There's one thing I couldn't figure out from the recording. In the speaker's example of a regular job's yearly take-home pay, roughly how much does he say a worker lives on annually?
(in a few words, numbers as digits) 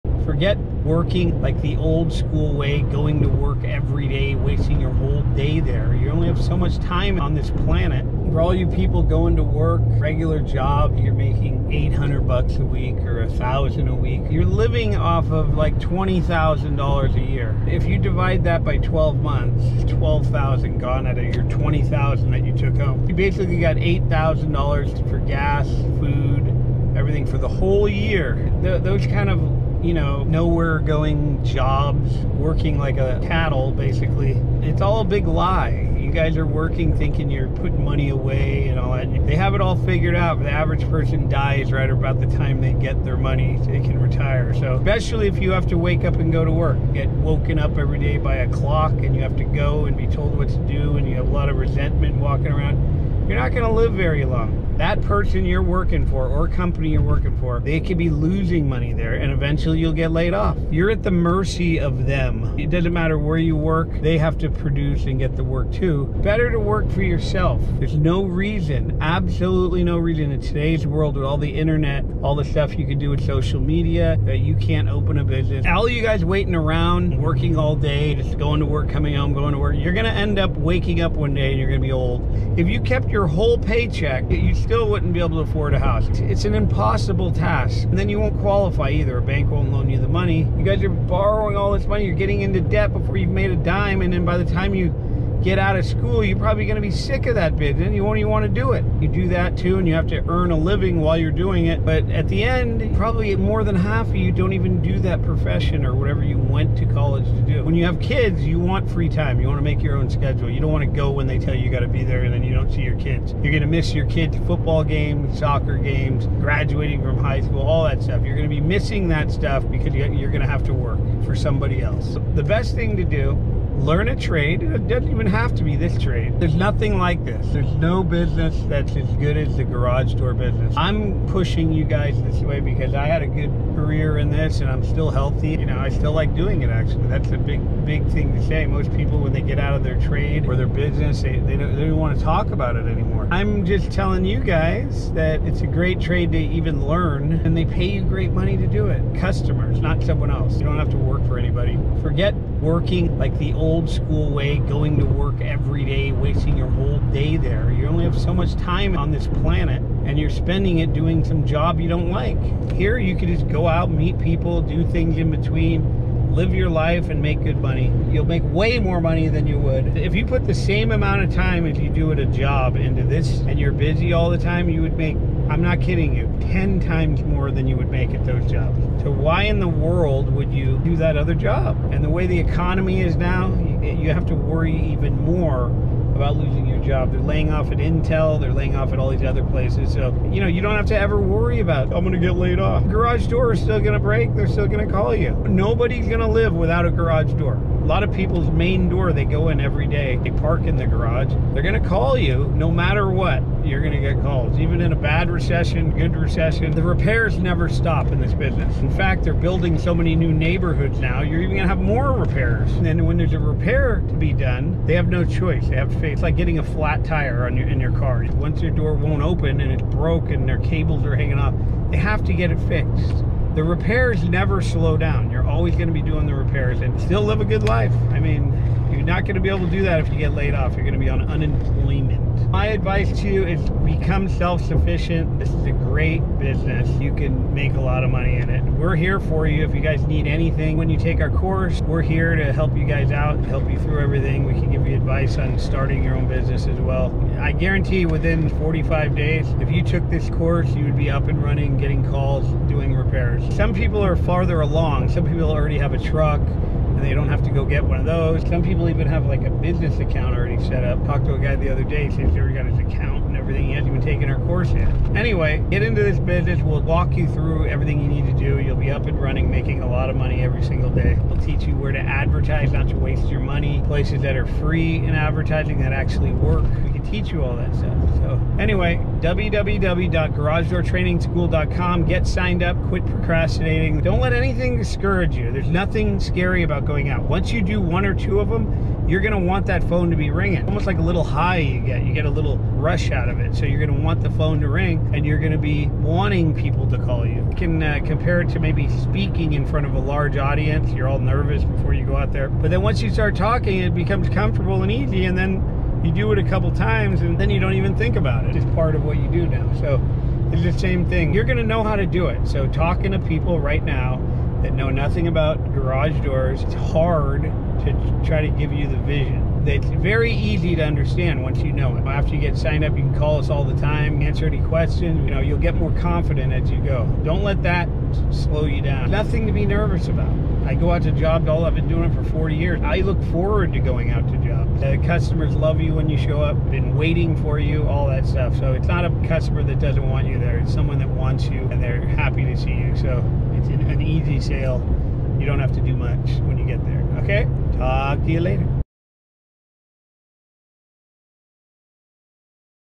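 $20,000.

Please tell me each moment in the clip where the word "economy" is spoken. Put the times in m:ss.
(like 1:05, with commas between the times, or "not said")
3:02.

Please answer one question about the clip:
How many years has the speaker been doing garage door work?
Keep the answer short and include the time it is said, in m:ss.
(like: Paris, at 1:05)
40, at 5:32.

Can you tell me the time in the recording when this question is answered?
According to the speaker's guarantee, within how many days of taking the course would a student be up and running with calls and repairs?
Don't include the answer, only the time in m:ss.
4:08.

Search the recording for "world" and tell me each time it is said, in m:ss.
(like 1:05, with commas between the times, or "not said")
1:10, 2:59.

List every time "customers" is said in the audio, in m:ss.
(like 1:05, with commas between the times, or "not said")
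2:29, 5:35, 5:39.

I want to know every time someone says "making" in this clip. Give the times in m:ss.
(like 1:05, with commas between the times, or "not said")
0:11, 4:29.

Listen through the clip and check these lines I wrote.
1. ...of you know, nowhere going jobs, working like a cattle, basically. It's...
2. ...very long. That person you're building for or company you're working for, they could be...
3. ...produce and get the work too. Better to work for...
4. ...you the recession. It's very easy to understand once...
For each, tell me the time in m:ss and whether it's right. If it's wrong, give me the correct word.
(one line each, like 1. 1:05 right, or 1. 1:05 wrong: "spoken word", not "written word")
1. 0:29 right
2. 0:53 wrong: "working", not "building"
3. 1:04 right
4. 5:18 wrong: "vision", not "recession".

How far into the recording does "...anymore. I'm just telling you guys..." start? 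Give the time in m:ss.
2:22.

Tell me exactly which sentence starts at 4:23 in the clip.
He hasn't even taken our course yet.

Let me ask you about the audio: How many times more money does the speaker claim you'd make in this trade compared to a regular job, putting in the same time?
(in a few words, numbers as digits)
10.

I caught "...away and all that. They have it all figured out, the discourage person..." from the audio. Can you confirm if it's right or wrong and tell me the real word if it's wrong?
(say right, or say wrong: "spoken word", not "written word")
wrong: "average", not "discourage".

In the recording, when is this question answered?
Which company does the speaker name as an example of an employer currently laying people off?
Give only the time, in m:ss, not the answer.
3:07.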